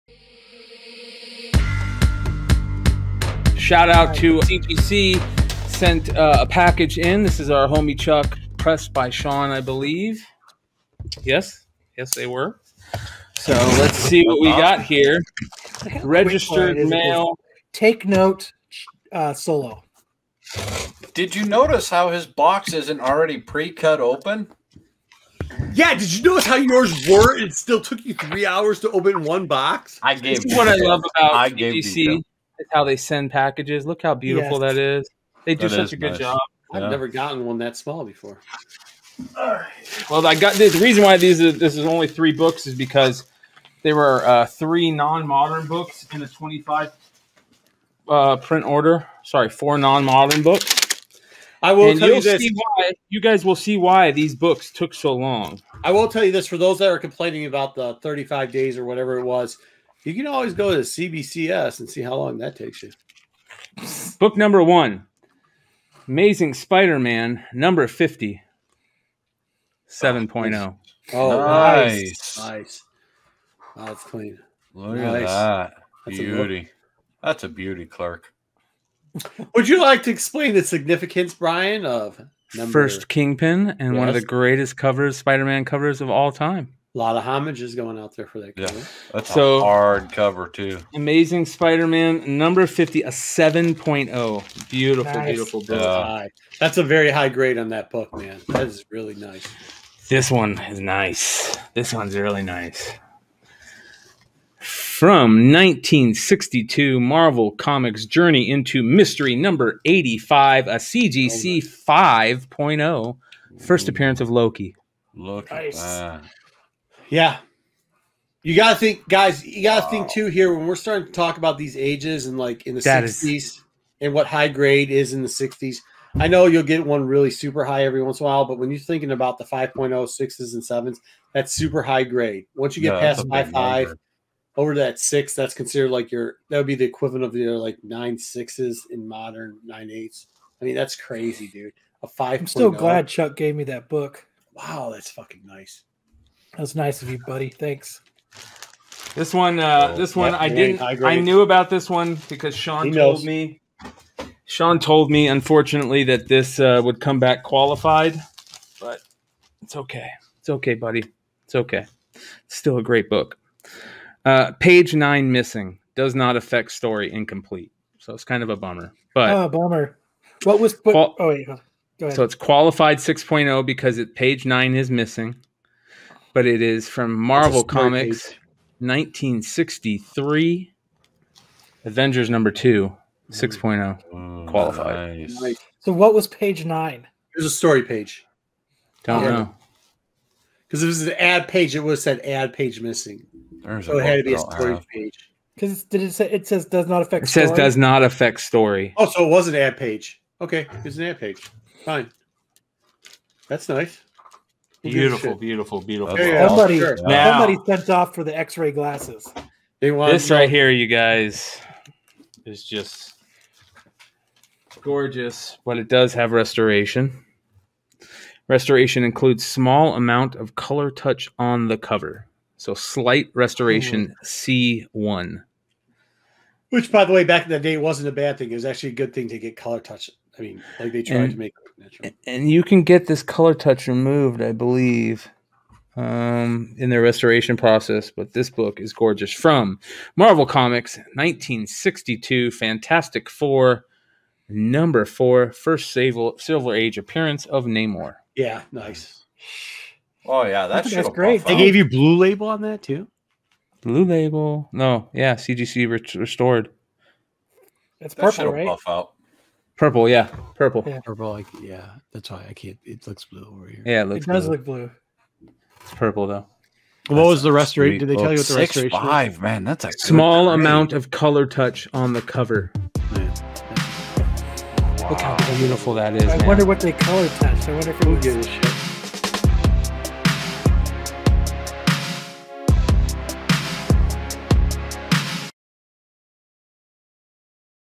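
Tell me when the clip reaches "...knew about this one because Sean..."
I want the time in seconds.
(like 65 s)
151 s.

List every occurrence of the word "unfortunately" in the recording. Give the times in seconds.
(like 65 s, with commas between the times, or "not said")
155 s.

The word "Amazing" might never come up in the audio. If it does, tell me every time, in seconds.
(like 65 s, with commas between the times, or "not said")
66 s, 90 s.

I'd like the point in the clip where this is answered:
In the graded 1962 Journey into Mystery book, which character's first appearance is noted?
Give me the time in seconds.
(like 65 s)
114 s.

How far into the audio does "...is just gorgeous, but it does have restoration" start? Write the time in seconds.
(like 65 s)
212 s.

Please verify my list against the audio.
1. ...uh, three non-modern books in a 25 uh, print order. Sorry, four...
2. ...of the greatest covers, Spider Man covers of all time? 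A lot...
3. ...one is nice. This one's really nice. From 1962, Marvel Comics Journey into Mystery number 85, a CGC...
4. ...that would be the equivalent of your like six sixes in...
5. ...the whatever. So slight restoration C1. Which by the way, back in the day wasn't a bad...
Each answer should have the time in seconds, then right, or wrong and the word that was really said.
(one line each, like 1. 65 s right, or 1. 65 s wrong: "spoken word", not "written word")
1. 44 s right
2. 84 s right
3. 100 s right
4. 136 s wrong: "nine", not "six"
5. 221 s wrong: "cover", not "whatever".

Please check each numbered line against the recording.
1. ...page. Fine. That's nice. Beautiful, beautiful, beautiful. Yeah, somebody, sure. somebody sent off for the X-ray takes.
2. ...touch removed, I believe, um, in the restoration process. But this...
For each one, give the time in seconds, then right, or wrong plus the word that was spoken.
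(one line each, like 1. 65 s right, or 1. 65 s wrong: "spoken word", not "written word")
1. 201 s wrong: "glasses", not "takes"
2. 233 s right.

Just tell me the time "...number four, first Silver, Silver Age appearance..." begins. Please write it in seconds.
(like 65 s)
244 s.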